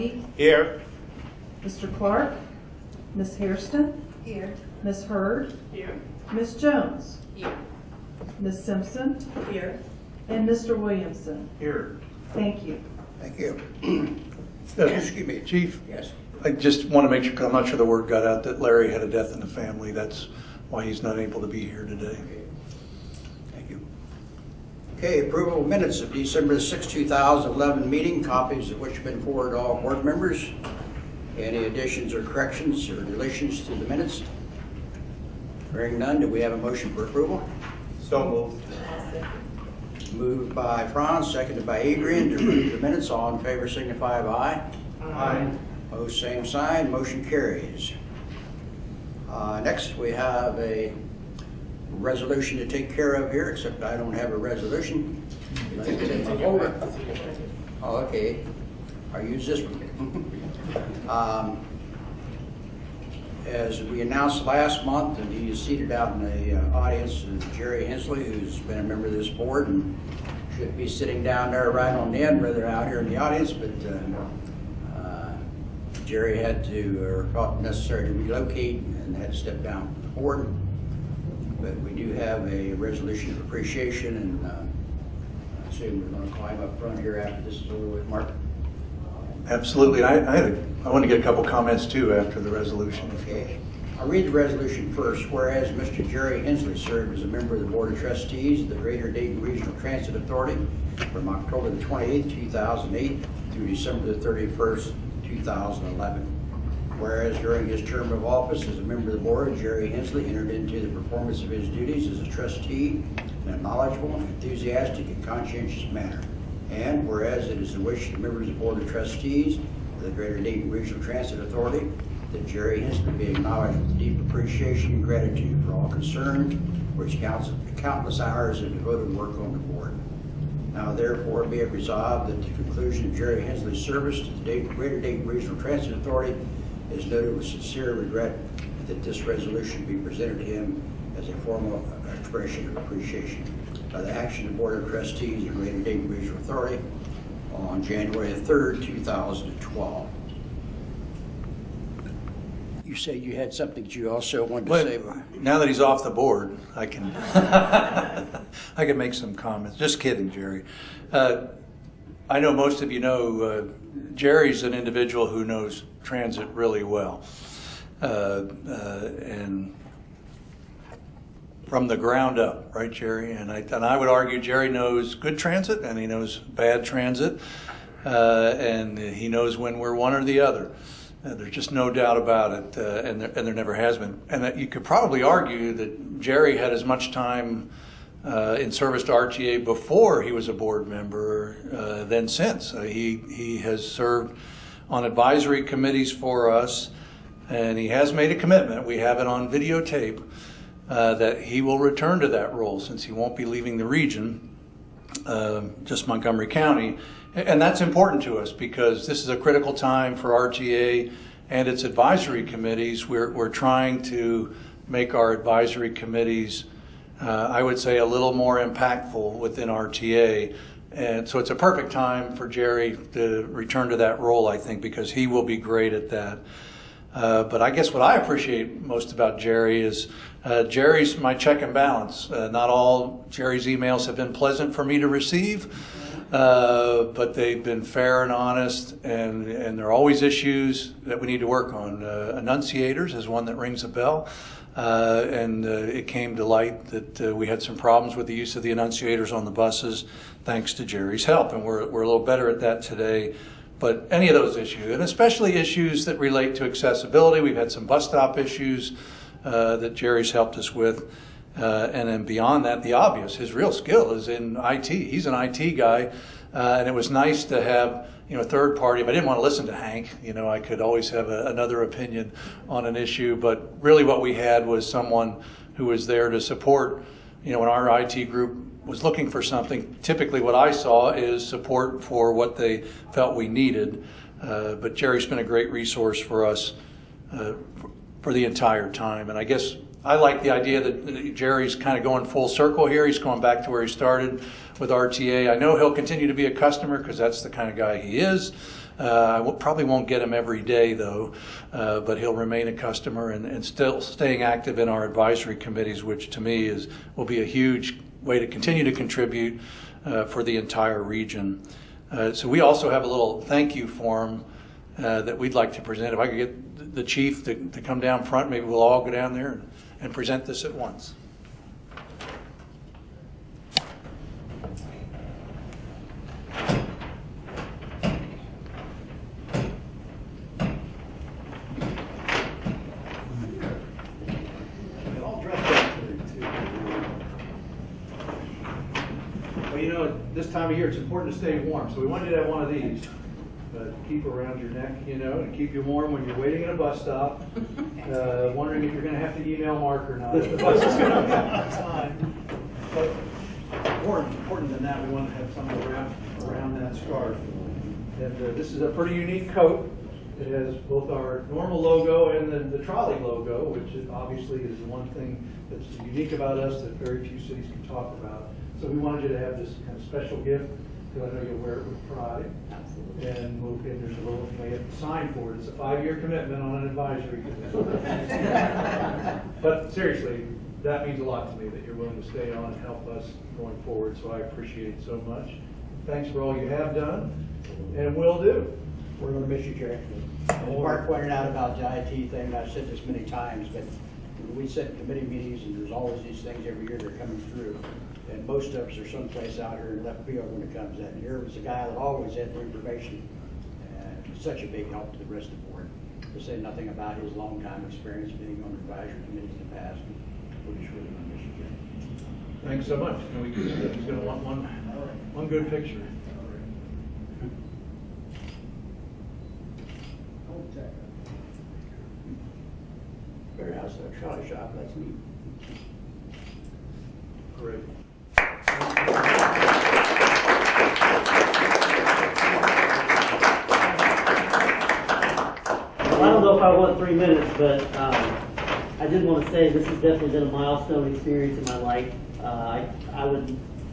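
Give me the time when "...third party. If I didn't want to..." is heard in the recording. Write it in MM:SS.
04:28.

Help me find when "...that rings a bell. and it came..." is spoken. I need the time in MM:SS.
04:03.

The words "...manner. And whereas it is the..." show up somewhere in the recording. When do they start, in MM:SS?
01:55.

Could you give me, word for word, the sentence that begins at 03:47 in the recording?
Uh, but I guess what I appreciate most about Jerry is uh, Jerry's my check and balance.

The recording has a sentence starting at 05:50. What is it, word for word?
the bus is going to on time.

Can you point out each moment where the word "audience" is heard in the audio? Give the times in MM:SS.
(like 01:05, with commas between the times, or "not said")
01:06, 01:13.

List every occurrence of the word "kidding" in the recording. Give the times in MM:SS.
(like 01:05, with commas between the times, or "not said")
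02:39.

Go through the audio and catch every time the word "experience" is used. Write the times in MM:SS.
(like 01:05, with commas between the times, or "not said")
06:47, 07:21.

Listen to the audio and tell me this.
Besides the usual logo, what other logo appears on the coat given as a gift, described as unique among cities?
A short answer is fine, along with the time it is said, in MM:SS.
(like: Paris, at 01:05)
trolley logo, at 06:02.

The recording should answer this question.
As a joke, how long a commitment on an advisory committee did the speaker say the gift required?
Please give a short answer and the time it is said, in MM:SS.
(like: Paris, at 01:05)
5 years, at 06:15.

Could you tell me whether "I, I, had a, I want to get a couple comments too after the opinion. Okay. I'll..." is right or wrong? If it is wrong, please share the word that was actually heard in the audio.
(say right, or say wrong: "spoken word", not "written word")
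wrong: "resolution", not "opinion".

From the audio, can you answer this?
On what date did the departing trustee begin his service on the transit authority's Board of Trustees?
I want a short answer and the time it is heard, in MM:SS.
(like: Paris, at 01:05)
October 28, 2008, at 01:41.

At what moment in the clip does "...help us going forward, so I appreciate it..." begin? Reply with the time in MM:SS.
06:22.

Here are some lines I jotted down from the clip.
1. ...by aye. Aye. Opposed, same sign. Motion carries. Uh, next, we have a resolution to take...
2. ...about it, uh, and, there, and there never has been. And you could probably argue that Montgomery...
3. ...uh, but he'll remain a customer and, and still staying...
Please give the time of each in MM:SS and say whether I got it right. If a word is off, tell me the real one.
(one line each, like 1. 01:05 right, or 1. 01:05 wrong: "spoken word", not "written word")
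1. 00:44 right
2. 03:02 wrong: "Jerry", not "Montgomery"
3. 05:01 right.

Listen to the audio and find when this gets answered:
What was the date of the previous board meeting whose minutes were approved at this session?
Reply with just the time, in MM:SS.
00:26.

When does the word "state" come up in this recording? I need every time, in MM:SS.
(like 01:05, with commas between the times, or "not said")
not said.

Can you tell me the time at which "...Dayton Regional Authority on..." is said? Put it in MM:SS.
02:25.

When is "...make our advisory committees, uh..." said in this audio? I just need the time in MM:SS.
03:34.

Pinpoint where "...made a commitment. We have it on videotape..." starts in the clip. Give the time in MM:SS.
03:18.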